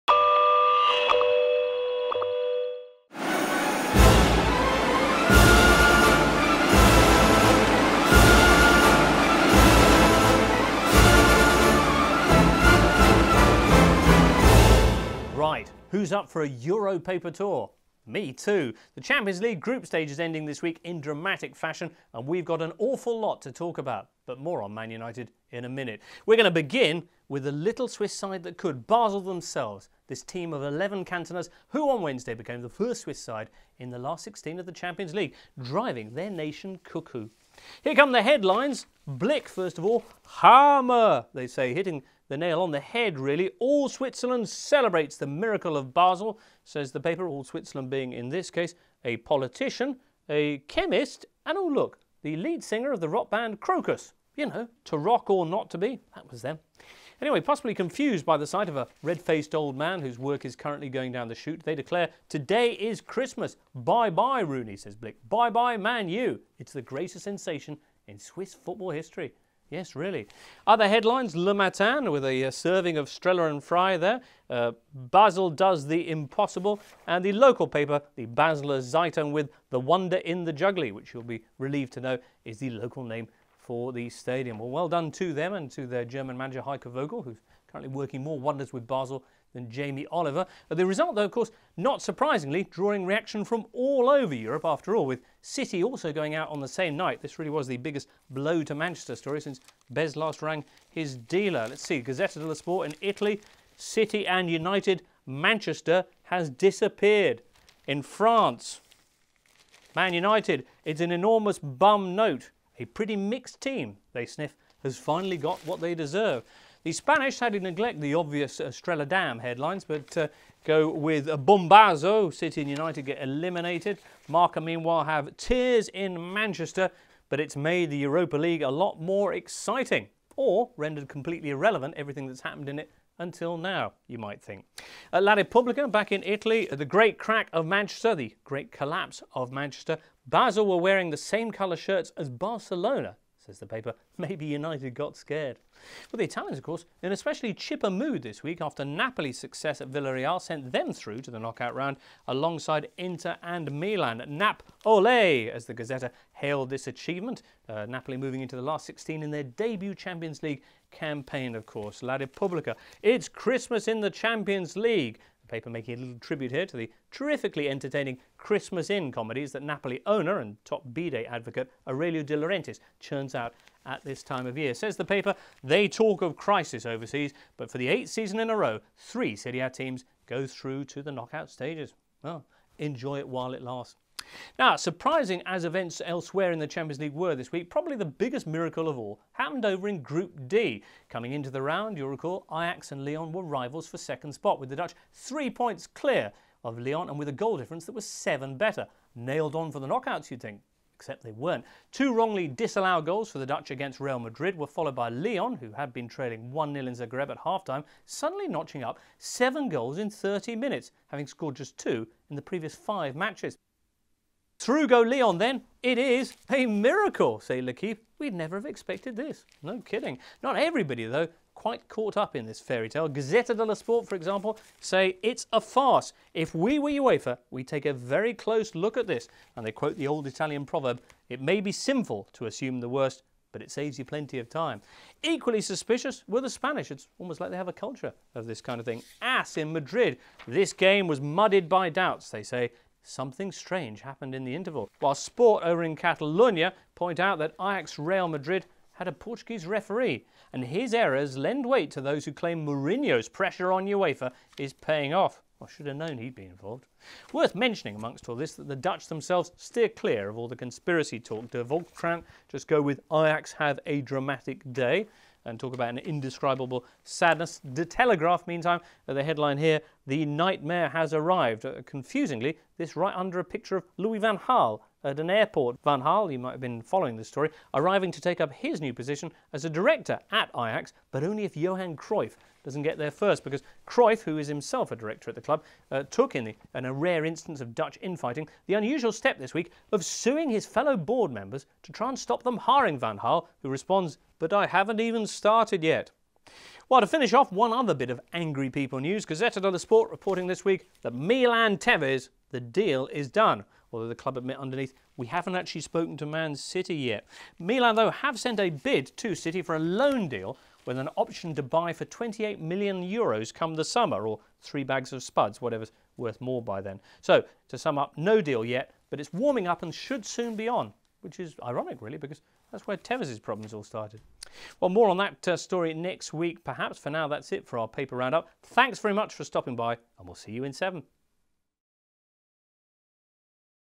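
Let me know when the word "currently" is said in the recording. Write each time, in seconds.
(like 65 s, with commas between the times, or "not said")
60 s, 87 s.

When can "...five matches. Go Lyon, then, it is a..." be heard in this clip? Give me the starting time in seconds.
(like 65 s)
212 s.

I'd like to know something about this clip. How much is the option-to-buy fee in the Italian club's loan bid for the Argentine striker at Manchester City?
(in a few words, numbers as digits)
28 million euros.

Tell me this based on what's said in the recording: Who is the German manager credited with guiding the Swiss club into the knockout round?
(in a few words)
Heiko Vogel.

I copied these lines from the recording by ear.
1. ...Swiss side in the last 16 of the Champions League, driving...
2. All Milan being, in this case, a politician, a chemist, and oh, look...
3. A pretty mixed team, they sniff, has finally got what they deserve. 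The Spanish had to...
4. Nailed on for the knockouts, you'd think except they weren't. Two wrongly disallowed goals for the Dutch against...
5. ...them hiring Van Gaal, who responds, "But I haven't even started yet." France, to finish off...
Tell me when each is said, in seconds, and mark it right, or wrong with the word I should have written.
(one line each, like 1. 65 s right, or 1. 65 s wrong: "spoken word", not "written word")
1. 33 s right
2. 47 s wrong: "Switzerland", not "Milan"
3. 112 s right
4. 199 s right
5. 292 s wrong: "Well", not "France".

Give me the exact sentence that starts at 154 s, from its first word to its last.
Nap ole, as the Gazzetta hailed this achievement.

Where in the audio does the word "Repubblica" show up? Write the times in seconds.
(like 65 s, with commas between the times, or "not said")
135 s, 162 s.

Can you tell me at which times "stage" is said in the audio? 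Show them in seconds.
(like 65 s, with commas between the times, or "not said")
19 s, 181 s.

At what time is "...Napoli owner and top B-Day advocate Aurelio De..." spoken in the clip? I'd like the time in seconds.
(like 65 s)
169 s.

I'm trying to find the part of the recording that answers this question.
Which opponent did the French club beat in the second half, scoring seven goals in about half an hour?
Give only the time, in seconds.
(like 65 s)
206 s.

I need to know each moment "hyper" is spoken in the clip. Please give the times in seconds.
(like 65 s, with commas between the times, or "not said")
not said.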